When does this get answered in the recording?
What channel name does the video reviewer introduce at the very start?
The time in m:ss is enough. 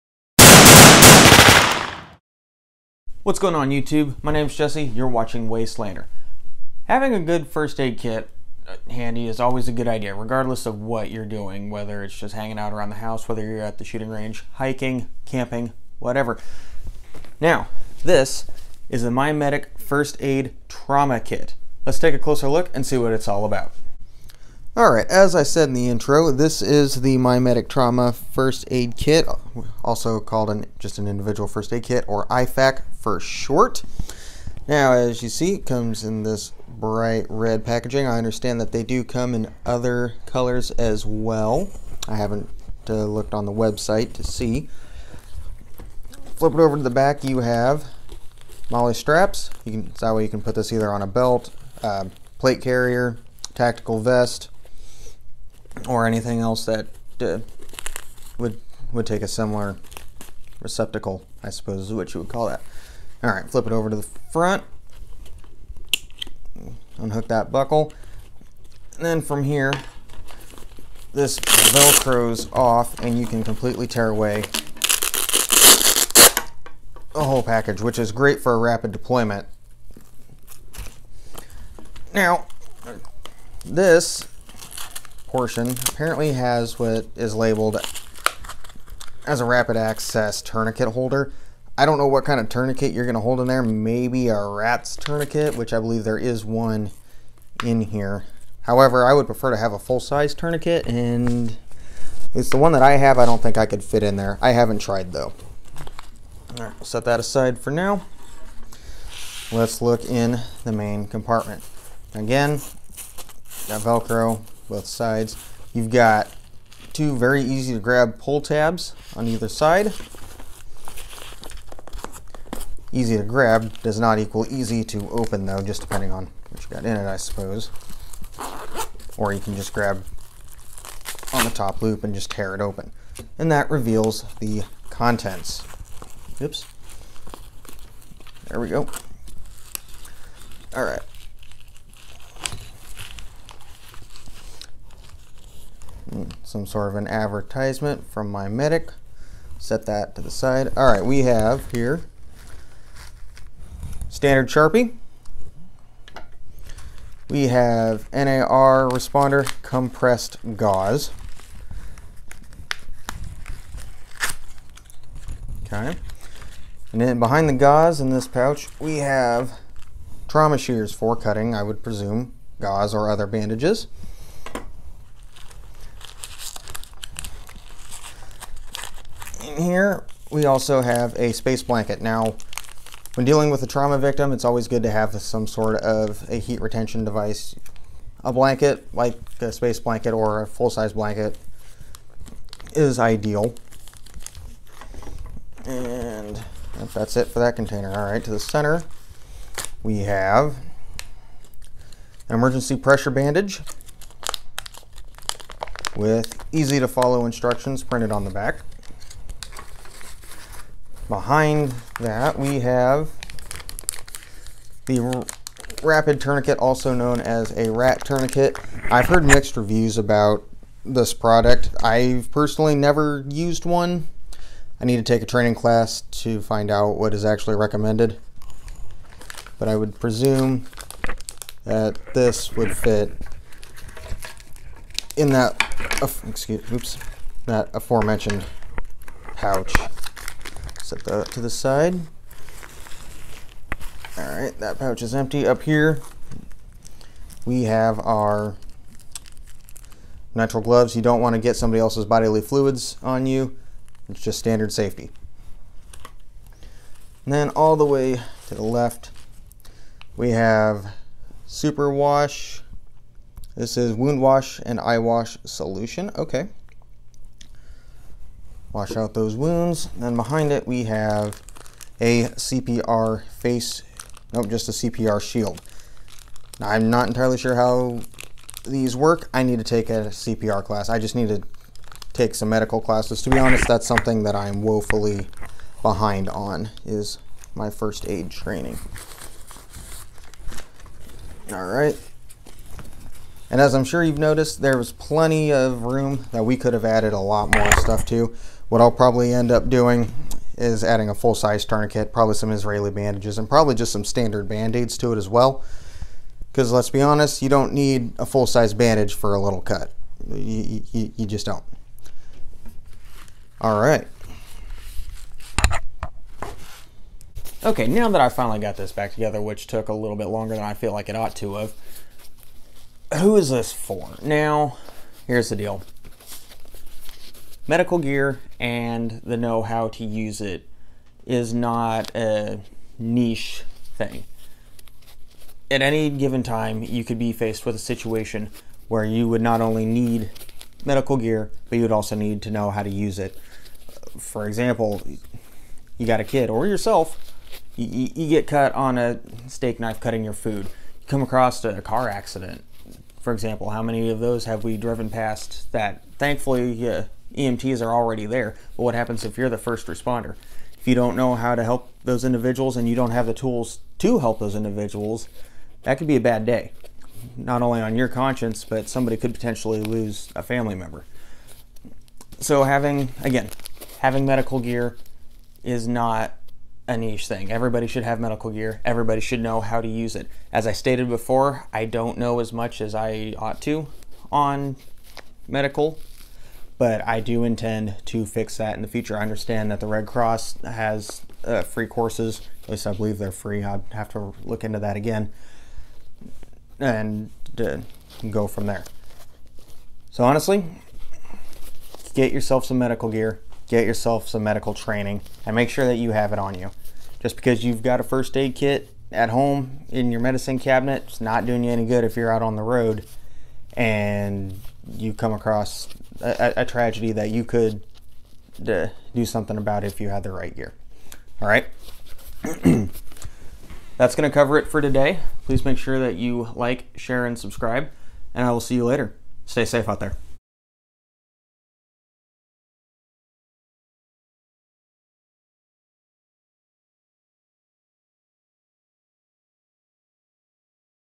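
0:05.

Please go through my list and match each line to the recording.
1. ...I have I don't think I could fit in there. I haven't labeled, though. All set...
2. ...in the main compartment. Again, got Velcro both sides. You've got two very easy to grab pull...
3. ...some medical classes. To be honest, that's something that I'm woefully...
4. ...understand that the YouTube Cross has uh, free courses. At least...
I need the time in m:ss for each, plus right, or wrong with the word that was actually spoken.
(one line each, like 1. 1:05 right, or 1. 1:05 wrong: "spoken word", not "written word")
1. 1:42 wrong: "tried", not "labeled"
2. 1:50 right
3. 4:42 right
4. 6:29 wrong: "Red", not "YouTube".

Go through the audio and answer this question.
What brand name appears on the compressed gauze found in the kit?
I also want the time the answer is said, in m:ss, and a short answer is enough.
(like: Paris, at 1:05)
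NAR, at 2:38.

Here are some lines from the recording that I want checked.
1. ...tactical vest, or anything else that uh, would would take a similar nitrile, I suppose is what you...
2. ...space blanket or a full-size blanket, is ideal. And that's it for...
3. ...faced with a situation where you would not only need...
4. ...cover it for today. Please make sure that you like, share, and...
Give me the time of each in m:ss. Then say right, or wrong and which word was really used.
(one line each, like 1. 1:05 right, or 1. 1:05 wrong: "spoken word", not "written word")
1. 0:53 wrong: "receptacle", not "nitrile"
2. 3:09 right
3. 5:37 right
4. 7:04 right.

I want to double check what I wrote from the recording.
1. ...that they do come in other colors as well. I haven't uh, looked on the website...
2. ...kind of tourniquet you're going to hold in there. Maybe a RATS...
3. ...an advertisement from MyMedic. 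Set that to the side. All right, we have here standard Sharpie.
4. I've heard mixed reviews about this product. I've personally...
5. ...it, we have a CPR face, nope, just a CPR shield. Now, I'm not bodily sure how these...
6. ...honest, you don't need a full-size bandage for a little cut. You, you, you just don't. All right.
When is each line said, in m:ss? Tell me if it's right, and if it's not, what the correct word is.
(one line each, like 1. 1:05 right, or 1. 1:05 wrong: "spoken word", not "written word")
1. 0:38 right
2. 1:32 right
3. 2:26 right
4. 3:38 right
5. 4:30 wrong: "entirely", not "bodily"
6. 5:07 right.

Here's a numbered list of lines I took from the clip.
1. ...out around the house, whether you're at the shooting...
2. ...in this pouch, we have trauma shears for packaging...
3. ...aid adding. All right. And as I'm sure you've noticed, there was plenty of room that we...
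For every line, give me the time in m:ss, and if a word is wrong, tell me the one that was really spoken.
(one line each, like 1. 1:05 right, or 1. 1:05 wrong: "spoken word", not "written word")
1. 0:12 right
2. 2:48 wrong: "cutting", not "packaging"
3. 4:48 wrong: "training", not "adding".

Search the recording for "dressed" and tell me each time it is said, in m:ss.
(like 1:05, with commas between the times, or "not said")
not said.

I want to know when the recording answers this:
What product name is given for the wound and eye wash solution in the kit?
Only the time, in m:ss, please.
4:21.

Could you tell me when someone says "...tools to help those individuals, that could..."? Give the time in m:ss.
6:03.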